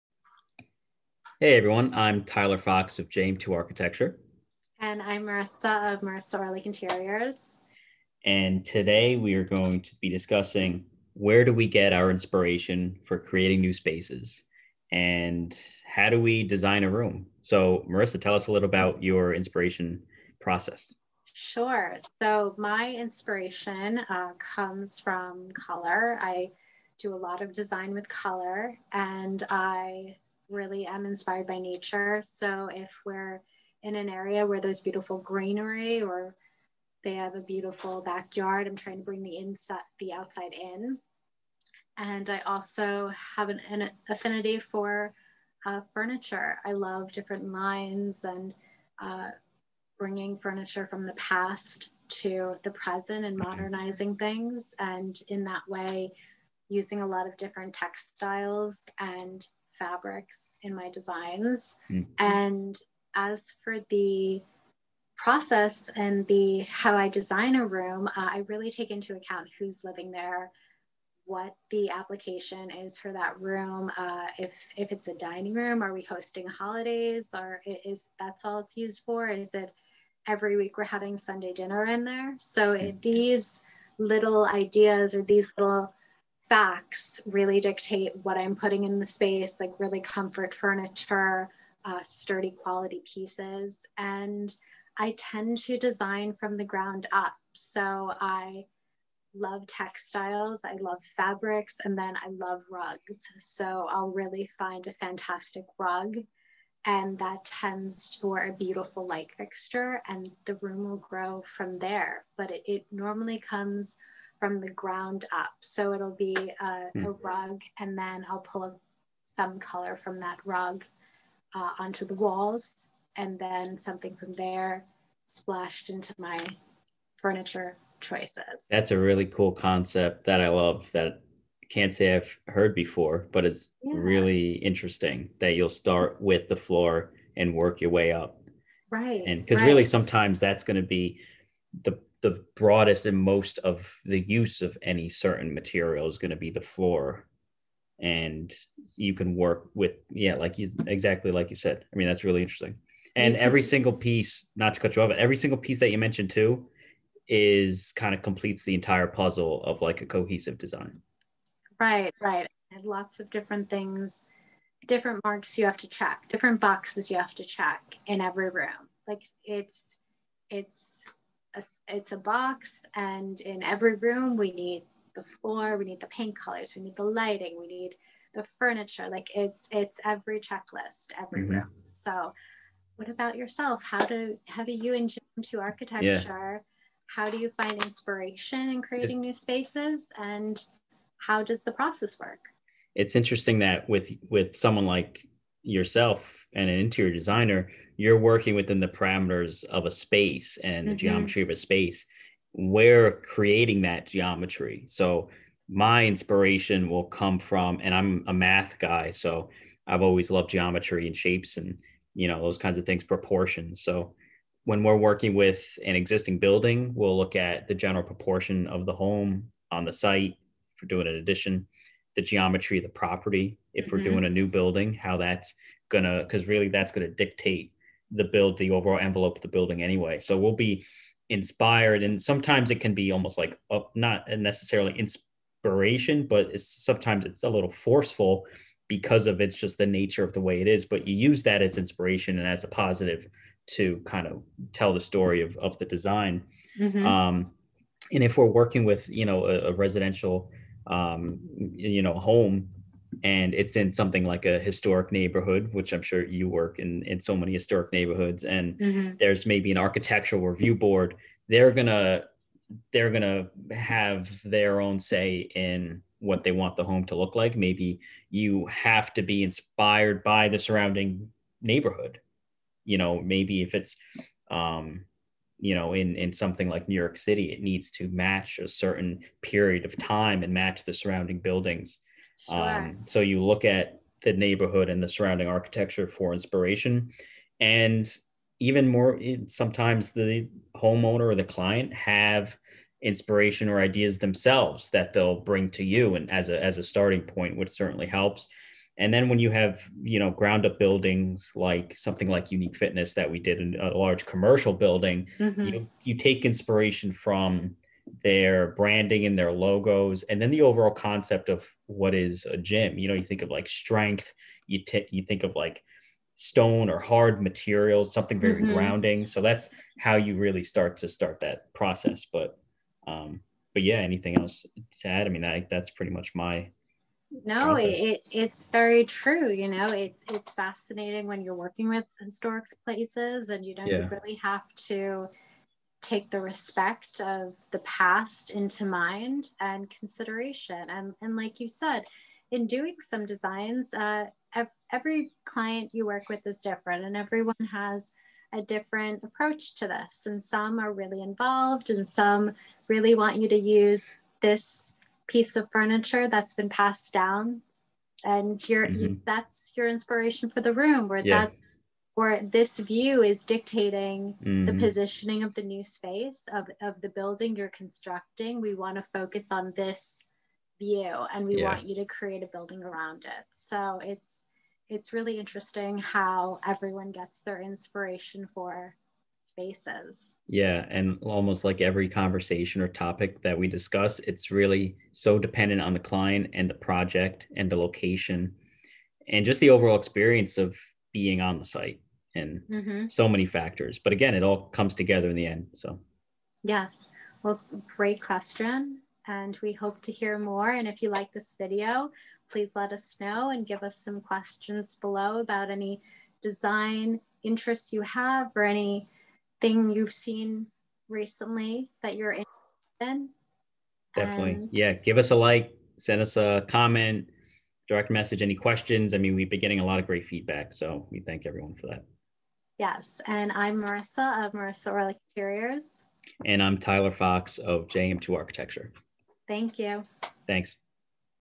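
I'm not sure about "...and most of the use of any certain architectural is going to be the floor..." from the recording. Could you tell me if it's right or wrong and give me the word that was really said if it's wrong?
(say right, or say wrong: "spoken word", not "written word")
wrong: "material", not "architectural".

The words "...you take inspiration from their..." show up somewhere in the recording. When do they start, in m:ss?
5:06.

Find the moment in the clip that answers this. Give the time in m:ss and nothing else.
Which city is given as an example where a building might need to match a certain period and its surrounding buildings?
4:36.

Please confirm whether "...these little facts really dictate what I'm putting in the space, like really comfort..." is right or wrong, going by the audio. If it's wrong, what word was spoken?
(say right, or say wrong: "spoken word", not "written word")
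right.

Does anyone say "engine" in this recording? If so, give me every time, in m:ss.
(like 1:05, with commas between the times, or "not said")
not said.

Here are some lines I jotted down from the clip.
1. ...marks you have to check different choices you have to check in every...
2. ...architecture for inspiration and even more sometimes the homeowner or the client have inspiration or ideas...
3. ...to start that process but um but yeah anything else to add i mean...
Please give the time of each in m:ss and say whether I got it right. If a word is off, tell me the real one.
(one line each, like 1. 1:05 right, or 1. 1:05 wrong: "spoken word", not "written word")
1. 2:45 wrong: "boxes", not "choices"
2. 4:45 right
3. 5:20 right.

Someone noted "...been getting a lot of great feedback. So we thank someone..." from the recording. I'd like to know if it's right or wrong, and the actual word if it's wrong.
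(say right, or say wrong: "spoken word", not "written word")
wrong: "everyone", not "someone".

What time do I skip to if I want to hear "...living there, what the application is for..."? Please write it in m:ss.
1:09.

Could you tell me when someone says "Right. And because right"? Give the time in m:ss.
2:18.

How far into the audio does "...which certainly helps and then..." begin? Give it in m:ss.
4:57.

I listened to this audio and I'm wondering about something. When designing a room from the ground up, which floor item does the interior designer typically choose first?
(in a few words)
a rug.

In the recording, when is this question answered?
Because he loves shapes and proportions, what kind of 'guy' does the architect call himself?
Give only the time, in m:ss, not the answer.
3:28.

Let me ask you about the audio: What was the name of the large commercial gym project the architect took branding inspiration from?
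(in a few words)
Unique Fitness.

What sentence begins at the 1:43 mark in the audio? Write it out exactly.
So I'll really find a fantastic rug.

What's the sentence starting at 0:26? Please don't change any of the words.
I do a lot of design with color and I really am inspired by nature.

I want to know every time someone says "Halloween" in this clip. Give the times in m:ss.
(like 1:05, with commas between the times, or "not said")
not said.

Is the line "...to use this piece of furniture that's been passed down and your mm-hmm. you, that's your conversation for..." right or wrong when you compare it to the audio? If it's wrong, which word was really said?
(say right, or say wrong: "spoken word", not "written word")
wrong: "inspiration", not "conversation".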